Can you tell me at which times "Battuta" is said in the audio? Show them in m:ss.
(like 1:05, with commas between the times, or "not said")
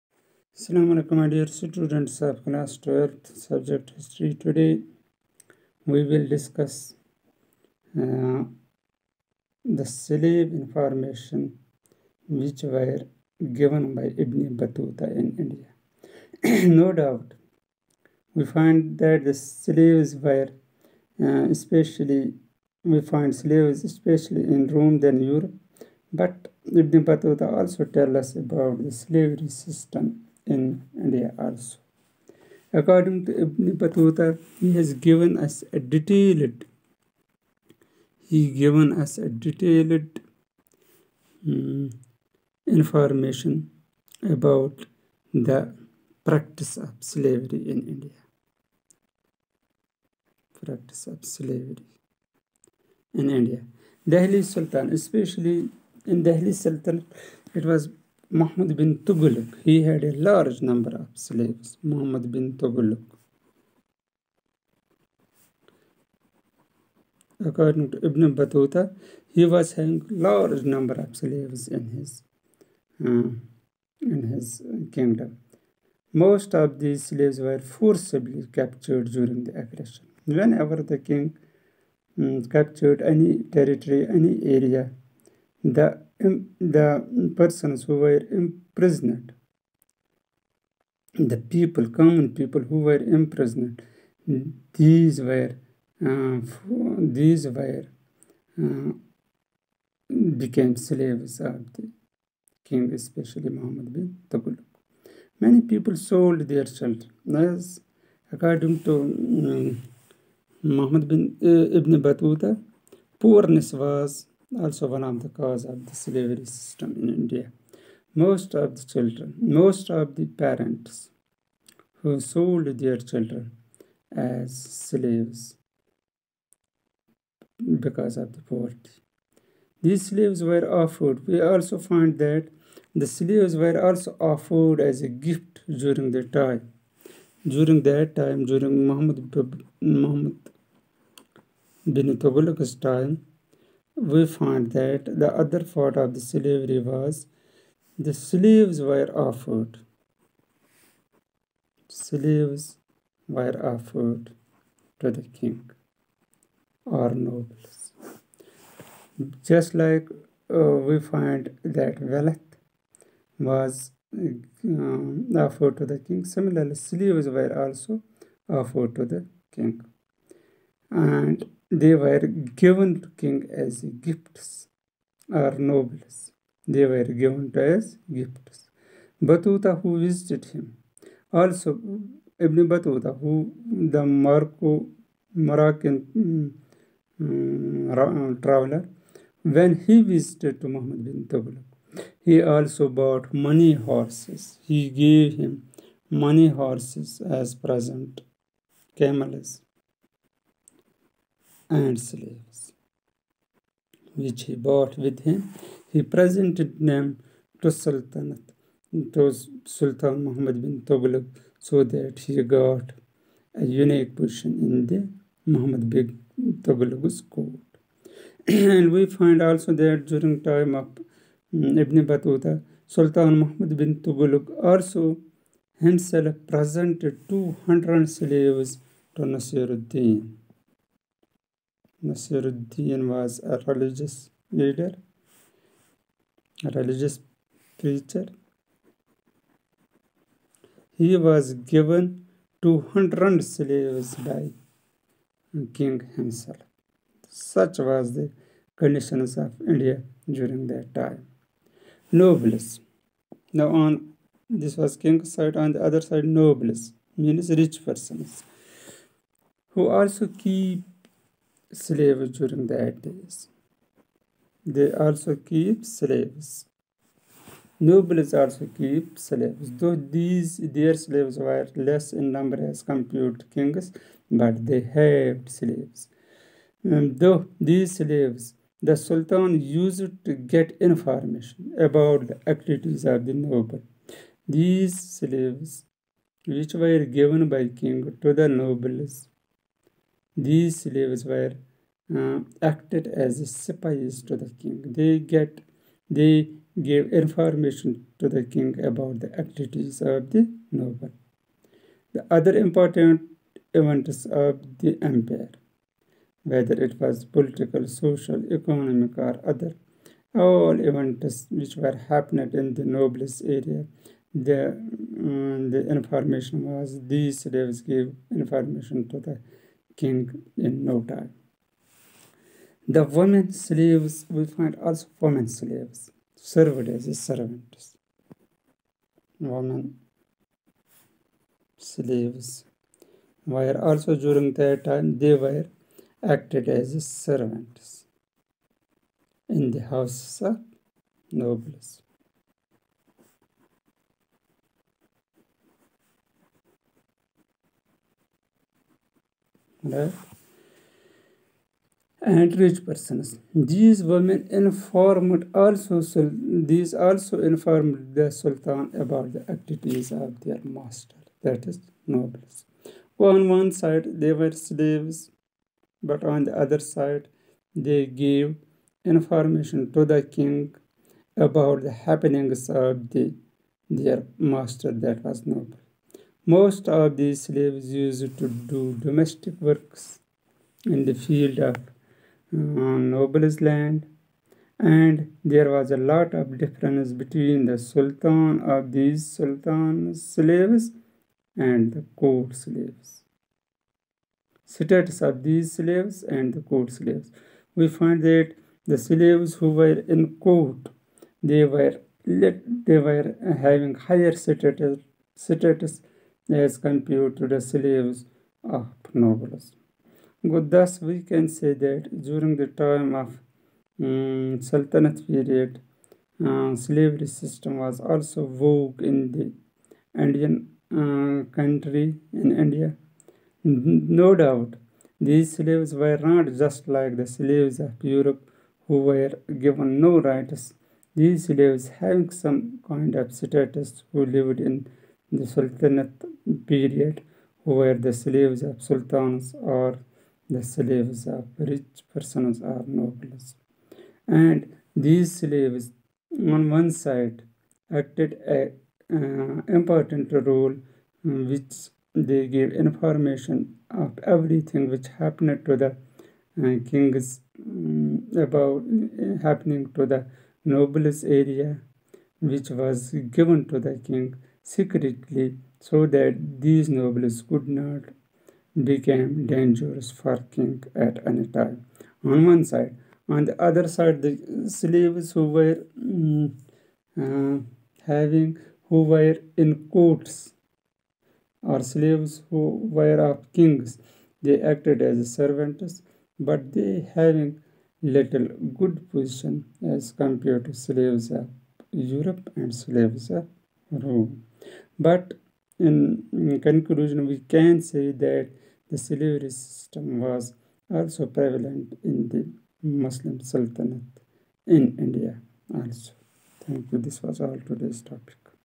0:14, 0:27, 0:33, 1:08, 3:42.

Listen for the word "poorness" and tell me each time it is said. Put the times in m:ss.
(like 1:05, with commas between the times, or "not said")
1:53.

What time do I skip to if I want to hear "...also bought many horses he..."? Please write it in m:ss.
3:12.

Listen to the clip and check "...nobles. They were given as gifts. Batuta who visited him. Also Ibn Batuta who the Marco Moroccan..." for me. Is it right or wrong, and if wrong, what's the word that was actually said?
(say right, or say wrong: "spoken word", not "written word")
right.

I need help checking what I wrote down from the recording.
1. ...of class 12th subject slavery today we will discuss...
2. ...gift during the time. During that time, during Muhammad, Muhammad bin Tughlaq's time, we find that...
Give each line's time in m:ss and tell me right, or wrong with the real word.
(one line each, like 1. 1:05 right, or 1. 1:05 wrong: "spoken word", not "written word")
1. 0:02 wrong: "history", not "slavery"
2. 2:15 right.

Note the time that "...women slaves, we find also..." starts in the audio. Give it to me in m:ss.
5:23.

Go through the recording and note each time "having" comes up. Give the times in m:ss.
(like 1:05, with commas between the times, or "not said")
1:09, 6:43, 7:11, 7:58, 8:07.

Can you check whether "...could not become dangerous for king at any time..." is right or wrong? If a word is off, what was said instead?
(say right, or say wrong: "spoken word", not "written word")
right.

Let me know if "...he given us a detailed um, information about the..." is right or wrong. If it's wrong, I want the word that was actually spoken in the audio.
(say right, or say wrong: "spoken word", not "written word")
right.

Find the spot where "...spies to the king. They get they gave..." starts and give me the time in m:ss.
4:53.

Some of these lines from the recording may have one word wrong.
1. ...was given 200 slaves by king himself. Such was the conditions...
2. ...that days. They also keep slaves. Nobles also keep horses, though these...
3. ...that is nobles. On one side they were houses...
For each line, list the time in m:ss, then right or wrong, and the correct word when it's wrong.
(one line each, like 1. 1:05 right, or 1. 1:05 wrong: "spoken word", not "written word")
1. 4:01 right
2. 4:22 wrong: "slaves", not "horses"
3. 6:01 wrong: "slaves", not "houses".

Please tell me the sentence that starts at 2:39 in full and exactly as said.
Just like uh, we find that wealth was um, offered to the king, similarly, slaves were also offered to the king.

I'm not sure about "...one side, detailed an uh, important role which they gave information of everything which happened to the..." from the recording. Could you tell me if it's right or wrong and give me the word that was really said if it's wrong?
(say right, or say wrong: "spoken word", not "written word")
wrong: "acted", not "detailed".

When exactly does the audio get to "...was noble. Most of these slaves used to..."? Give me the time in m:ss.
6:15.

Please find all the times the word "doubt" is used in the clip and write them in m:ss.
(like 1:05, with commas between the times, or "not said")
0:16, 7:04.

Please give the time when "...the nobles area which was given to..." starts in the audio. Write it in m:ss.
7:40.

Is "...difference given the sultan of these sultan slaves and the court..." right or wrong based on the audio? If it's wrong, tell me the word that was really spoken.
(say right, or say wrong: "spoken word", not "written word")
wrong: "between", not "given".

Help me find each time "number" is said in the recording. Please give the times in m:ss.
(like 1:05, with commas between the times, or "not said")
1:00, 1:10, 4:32.